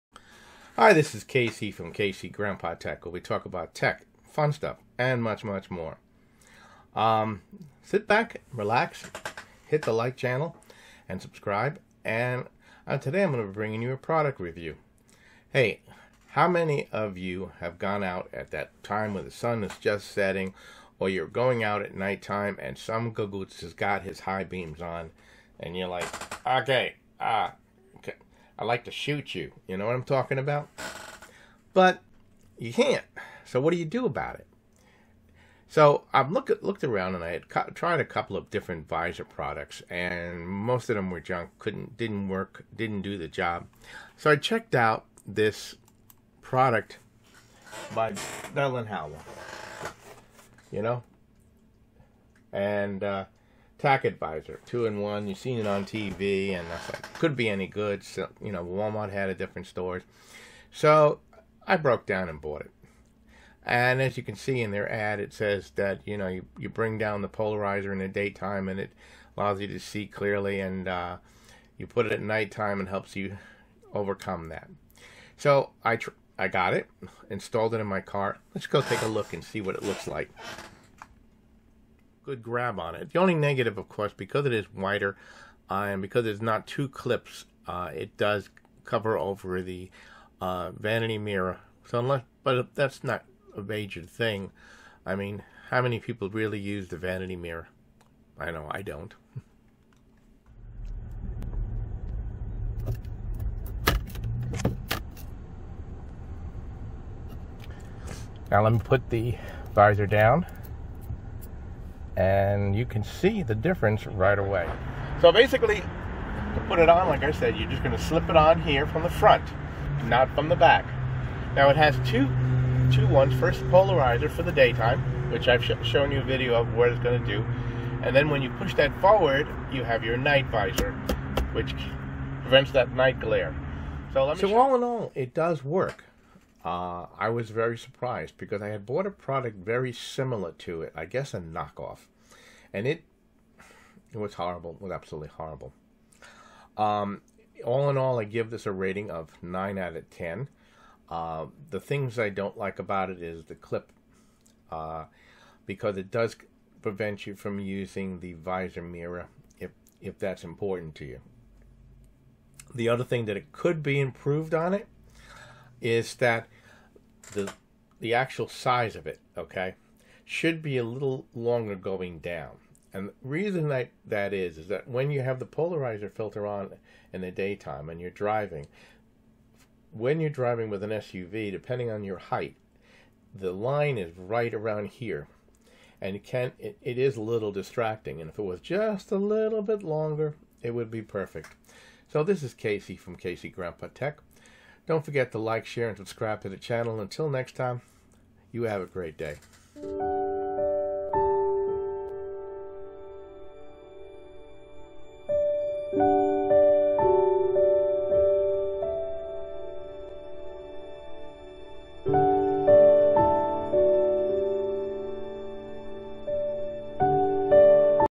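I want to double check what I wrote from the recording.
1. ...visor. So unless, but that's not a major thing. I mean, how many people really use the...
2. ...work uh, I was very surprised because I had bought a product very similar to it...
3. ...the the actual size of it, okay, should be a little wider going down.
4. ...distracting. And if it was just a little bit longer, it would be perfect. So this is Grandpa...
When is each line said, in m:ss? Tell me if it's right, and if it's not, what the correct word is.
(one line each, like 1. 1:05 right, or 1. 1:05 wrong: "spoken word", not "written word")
1. 1:31 wrong: "mirror", not "visor"
2. 2:15 right
3. 2:47 wrong: "longer", not "wider"
4. 3:07 wrong: "Casey", not "Grandpa".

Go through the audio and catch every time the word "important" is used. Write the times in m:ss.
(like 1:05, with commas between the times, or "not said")
2:40.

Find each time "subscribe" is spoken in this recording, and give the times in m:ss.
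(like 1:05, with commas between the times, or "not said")
0:11, 3:15.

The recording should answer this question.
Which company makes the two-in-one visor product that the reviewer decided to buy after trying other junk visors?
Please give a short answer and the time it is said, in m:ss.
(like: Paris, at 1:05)
Bell and Howell, at 0:48.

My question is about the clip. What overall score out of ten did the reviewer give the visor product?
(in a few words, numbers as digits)
9.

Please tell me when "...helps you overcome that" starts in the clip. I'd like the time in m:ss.
1:12.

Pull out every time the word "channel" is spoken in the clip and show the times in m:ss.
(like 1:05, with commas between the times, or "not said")
0:10, 3:16.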